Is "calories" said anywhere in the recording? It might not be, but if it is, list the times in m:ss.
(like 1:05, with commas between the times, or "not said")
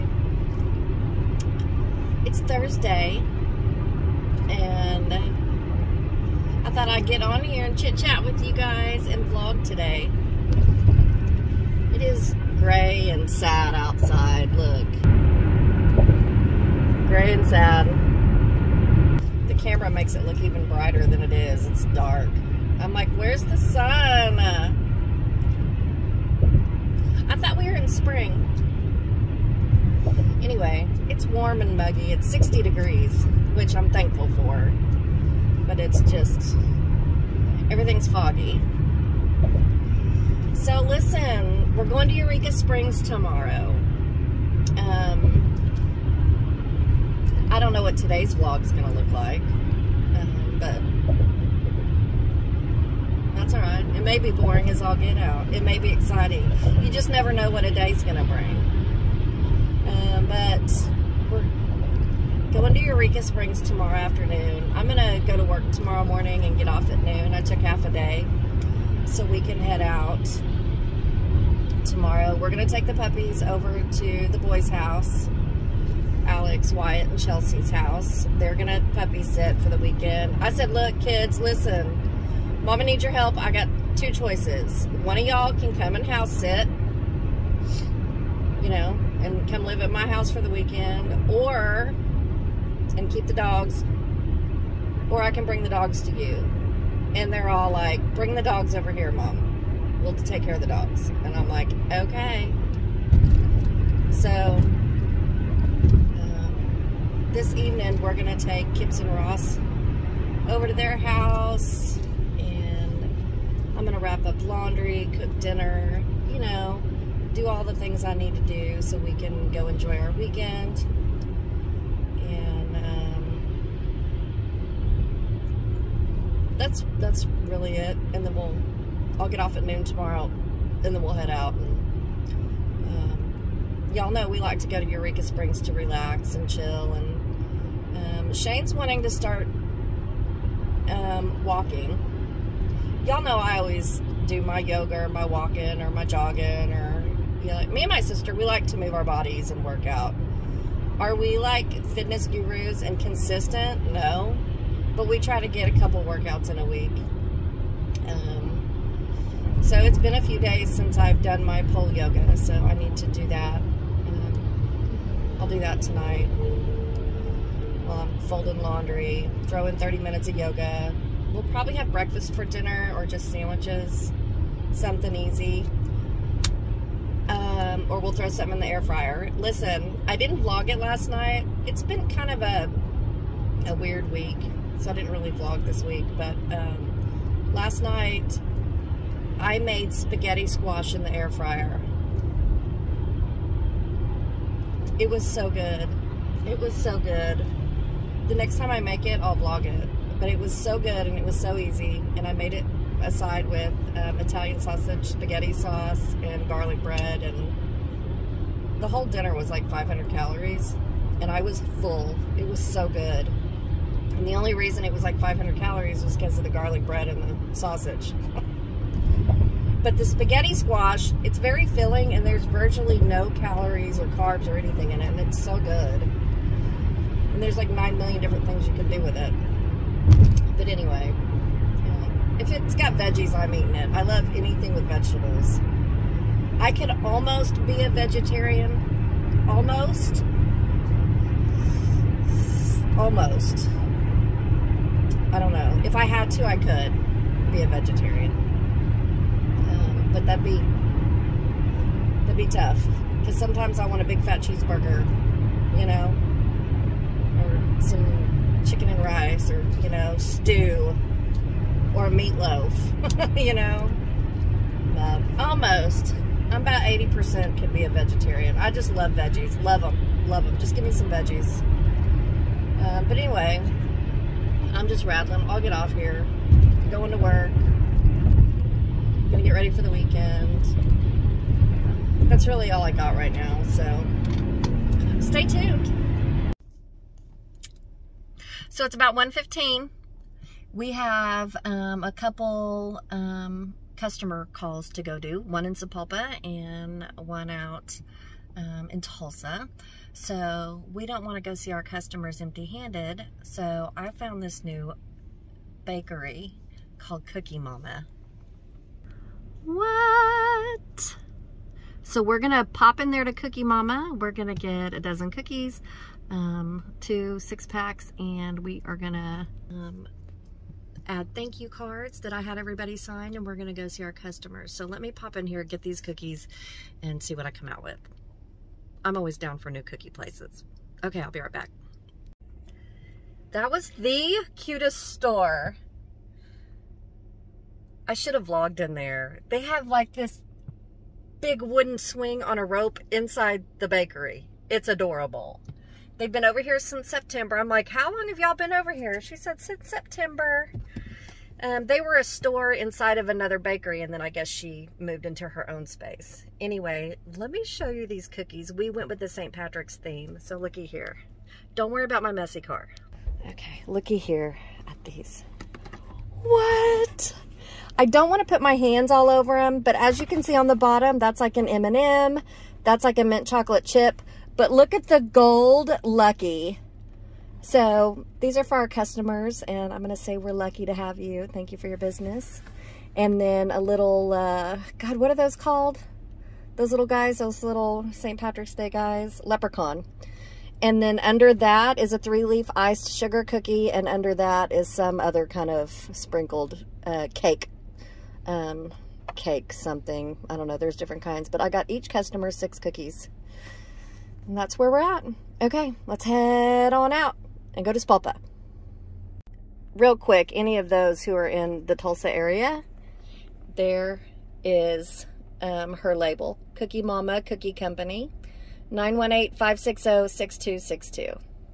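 3:30, 3:35, 3:43.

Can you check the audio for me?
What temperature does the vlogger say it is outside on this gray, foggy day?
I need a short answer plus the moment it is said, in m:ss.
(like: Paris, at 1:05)
60 degrees, at 0:32.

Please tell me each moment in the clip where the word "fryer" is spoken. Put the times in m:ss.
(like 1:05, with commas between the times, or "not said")
2:58, 3:11.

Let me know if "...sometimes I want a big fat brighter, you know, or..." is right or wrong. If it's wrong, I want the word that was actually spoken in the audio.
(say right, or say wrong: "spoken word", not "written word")
wrong: "cheeseburger", not "brighter".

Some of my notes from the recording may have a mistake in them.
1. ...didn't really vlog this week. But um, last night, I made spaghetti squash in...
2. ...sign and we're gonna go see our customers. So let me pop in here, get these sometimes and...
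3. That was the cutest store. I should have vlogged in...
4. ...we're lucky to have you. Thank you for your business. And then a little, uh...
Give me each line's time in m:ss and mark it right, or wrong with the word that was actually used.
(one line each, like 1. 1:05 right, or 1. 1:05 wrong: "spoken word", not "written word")
1. 3:04 right
2. 5:22 wrong: "cookies", not "sometimes"
3. 5:33 right
4. 6:20 right.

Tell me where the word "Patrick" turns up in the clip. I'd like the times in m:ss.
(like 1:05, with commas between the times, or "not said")
5:59, 6:28.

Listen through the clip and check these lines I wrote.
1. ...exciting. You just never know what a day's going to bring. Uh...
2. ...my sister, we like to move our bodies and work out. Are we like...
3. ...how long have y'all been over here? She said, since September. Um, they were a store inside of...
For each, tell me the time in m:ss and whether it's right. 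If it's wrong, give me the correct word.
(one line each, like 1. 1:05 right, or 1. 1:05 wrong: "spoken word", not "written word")
1. 0:55 right
2. 2:27 right
3. 5:47 right.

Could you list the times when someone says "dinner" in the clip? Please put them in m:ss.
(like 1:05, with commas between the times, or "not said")
1:55, 2:52, 3:29.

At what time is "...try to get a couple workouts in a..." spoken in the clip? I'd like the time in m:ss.
2:35.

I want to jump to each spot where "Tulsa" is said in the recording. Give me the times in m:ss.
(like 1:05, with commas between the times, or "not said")
4:59, 6:51.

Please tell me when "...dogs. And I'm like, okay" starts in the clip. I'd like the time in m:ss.
1:40.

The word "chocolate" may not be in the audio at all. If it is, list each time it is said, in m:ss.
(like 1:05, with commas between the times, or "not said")
6:13.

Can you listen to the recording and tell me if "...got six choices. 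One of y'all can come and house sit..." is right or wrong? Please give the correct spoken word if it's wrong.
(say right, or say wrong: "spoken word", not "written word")
wrong: "two", not "six".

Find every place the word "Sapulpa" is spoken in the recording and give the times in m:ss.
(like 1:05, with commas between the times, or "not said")
4:55, 6:47.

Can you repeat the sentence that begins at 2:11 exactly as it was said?
And um, y'all know we like to go to Eureka Springs to relax and chill.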